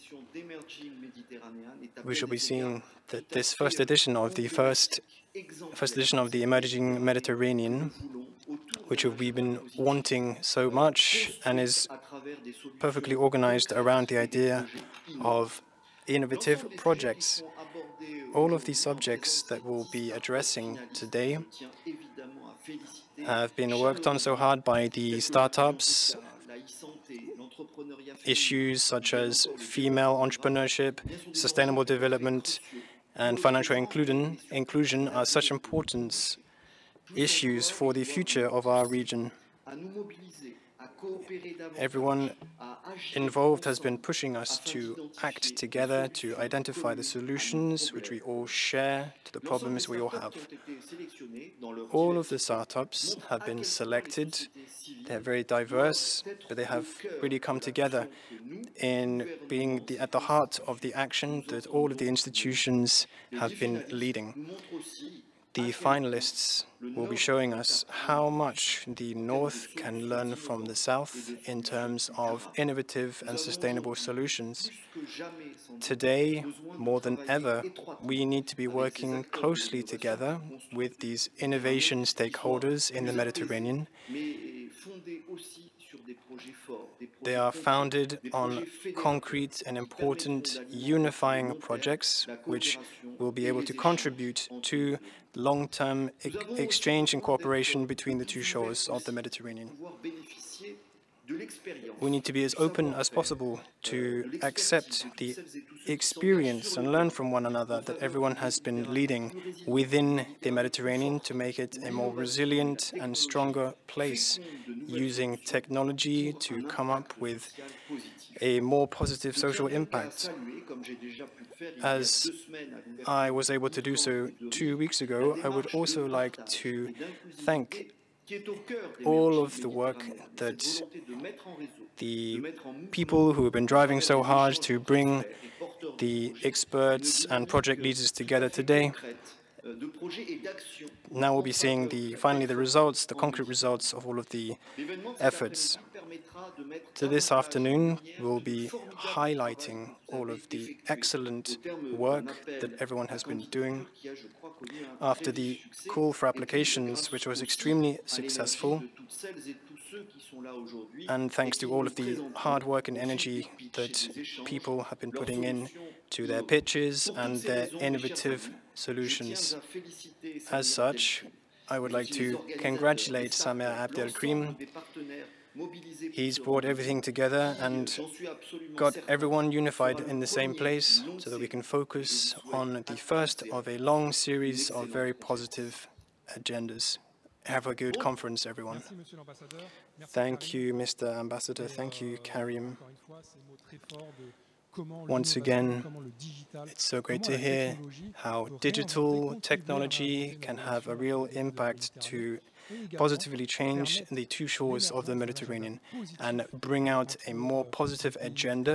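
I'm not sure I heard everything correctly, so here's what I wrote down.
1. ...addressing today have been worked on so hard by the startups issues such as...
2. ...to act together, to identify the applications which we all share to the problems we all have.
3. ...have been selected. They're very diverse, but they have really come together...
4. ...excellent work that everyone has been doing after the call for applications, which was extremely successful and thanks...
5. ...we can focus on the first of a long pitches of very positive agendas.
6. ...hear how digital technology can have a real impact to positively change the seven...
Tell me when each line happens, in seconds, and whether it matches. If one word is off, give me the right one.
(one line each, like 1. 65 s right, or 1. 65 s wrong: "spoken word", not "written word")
1. 20 s right
2. 44 s wrong: "solutions", not "applications"
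3. 53 s right
4. 150 s right
5. 181 s wrong: "series", not "pitches"
6. 197 s wrong: "two", not "seven".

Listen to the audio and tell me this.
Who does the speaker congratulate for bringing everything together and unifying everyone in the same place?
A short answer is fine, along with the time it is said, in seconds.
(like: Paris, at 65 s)
Abdel Abdelkrim, at 173 s.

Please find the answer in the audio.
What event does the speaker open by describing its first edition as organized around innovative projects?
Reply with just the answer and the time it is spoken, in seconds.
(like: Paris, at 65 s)
Emerging Mediterranean, at 6 s.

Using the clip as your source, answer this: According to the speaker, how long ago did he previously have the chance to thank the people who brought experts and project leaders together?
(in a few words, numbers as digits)
Two weeks ago.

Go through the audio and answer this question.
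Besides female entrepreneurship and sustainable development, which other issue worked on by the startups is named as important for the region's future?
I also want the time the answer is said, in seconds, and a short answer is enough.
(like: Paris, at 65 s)
Financial inclusion, at 33 s.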